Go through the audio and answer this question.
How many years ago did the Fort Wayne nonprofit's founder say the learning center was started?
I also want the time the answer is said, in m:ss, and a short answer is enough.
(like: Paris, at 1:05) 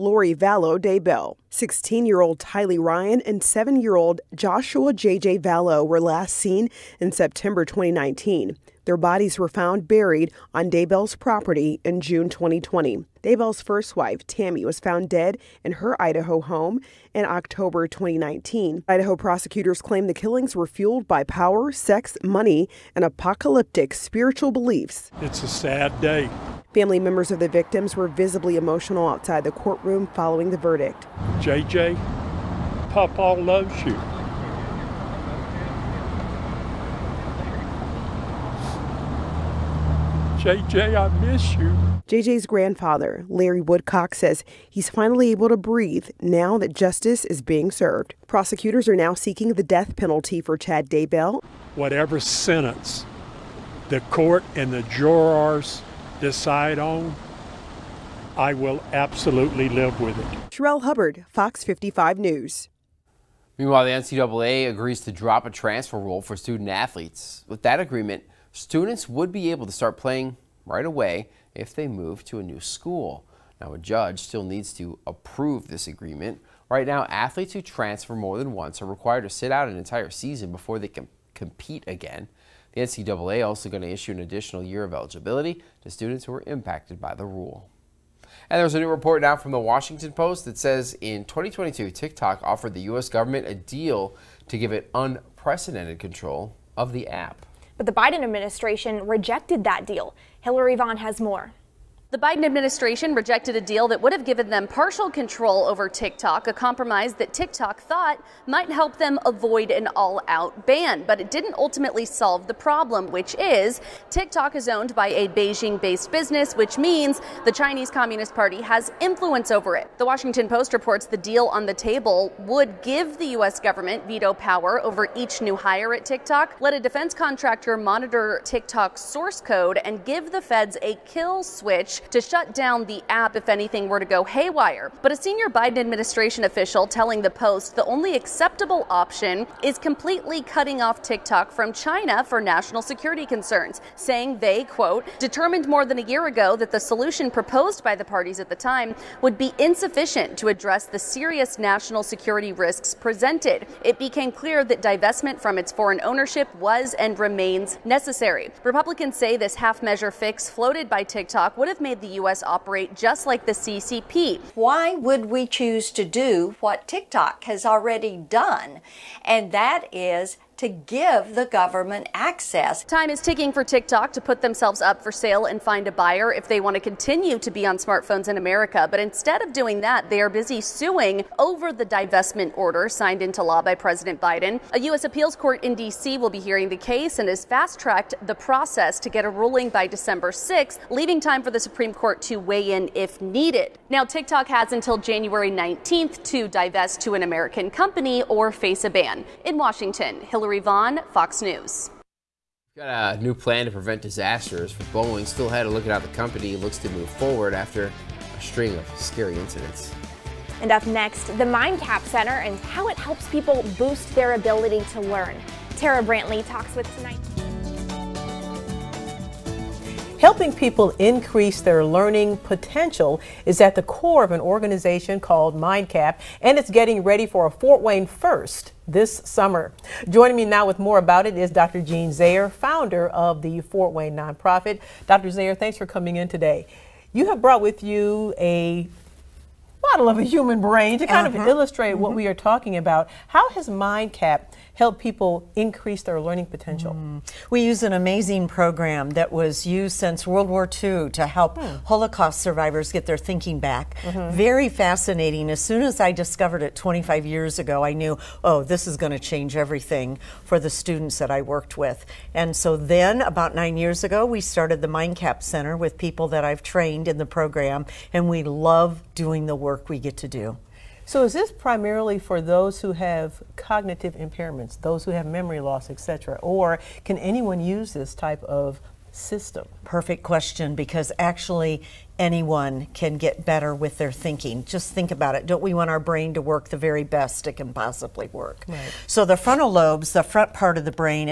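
9, at 4:23.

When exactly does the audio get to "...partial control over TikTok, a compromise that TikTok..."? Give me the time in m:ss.
1:44.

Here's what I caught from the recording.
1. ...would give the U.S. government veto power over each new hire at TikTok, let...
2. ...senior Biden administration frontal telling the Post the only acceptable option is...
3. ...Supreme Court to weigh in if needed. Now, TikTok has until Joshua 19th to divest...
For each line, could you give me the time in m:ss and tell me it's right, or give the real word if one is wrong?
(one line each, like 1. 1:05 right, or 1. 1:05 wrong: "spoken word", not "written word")
1. 2:02 right
2. 2:15 wrong: "official", not "frontal"
3. 3:11 wrong: "January", not "Joshua".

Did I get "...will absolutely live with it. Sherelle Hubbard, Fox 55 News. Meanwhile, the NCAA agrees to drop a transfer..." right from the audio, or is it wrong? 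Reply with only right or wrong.
right.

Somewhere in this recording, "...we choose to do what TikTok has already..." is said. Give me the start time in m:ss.
2:45.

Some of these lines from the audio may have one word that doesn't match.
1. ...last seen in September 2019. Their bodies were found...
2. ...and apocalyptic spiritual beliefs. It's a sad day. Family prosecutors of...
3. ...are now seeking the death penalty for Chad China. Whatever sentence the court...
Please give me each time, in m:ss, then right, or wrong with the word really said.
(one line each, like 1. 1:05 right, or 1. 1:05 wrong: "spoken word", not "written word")
1. 0:05 right
2. 0:22 wrong: "members", not "prosecutors"
3. 0:48 wrong: "Daybell", not "China".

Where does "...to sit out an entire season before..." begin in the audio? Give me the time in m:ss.
1:19.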